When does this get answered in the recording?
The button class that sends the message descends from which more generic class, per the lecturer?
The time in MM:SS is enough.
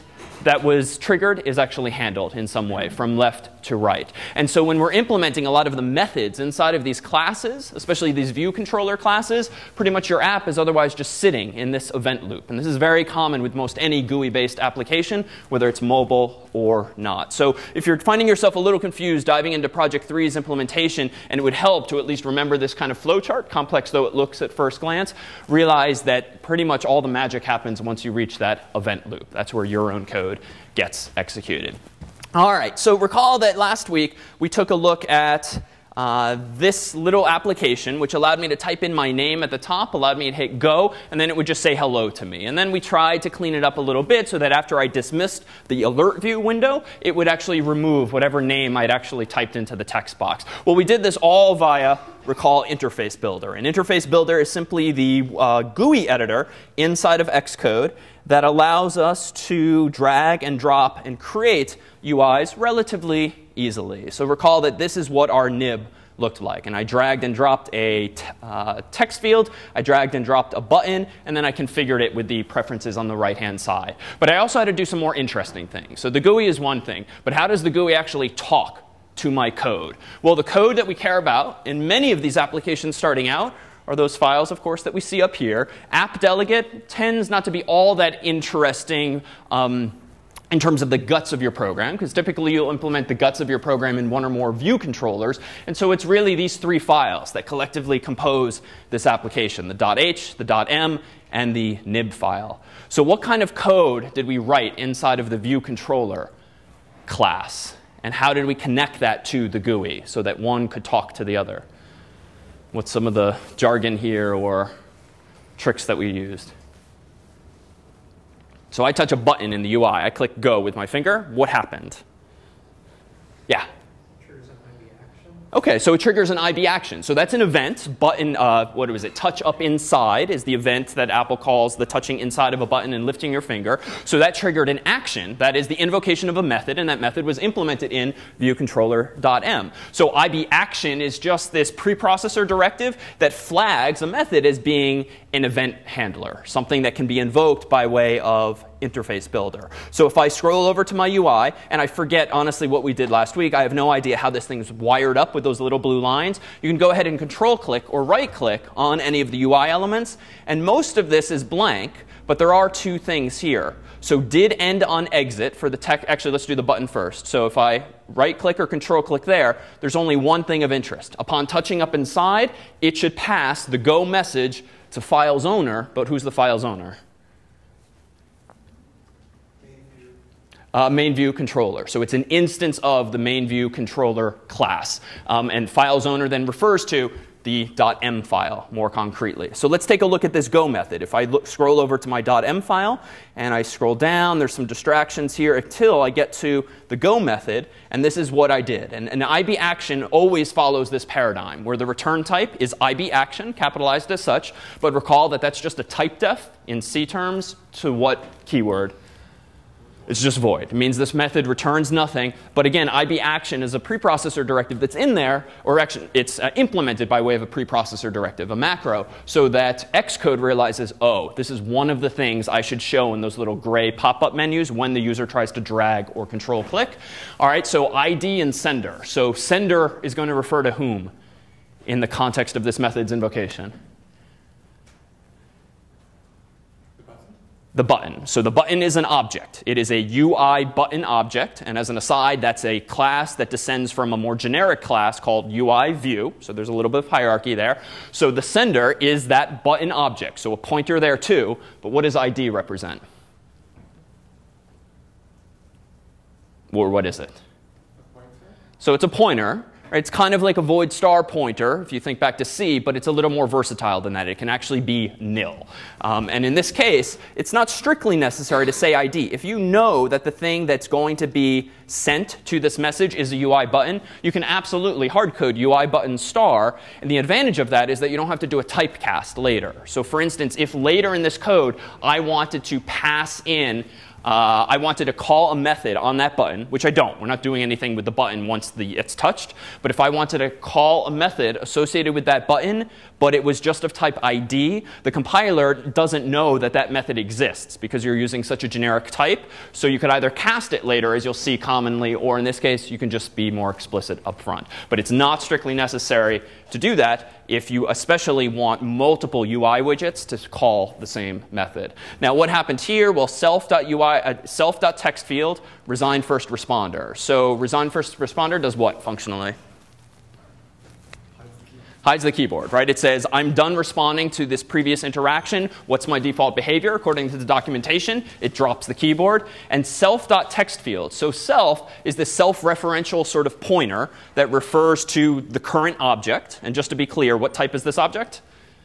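04:05.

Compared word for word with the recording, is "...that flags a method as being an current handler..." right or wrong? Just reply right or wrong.
wrong.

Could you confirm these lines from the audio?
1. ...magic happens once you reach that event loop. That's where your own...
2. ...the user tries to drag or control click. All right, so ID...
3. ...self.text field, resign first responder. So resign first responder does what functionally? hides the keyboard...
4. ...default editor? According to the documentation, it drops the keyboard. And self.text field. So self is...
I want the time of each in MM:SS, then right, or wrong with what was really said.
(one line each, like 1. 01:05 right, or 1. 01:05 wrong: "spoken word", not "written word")
1. 00:27 right
2. 03:44 right
3. 05:14 right
4. 05:26 wrong: "behavior", not "editor".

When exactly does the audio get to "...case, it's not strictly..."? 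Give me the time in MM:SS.
04:26.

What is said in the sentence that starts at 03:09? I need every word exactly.
So let's take a look at this go method.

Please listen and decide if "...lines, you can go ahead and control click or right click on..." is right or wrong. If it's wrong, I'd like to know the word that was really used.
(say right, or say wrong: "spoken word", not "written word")
right.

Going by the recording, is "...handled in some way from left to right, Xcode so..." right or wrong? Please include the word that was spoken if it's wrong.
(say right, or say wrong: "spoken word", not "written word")
wrong: "And", not "Xcode".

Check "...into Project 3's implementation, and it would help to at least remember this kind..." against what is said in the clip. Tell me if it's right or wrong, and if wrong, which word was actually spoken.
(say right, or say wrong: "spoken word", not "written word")
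right.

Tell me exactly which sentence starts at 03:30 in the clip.
It means this method returns nothing.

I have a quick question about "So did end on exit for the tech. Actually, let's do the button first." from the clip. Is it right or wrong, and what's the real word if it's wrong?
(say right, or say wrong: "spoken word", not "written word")
right.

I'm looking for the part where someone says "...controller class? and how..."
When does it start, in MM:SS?
01:45.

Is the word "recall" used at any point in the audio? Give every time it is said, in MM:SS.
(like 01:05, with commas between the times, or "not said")
00:32, 00:52, 01:04, 03:24.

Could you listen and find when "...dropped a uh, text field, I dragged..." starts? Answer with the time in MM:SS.
01:07.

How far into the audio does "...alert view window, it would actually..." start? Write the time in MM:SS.
00:45.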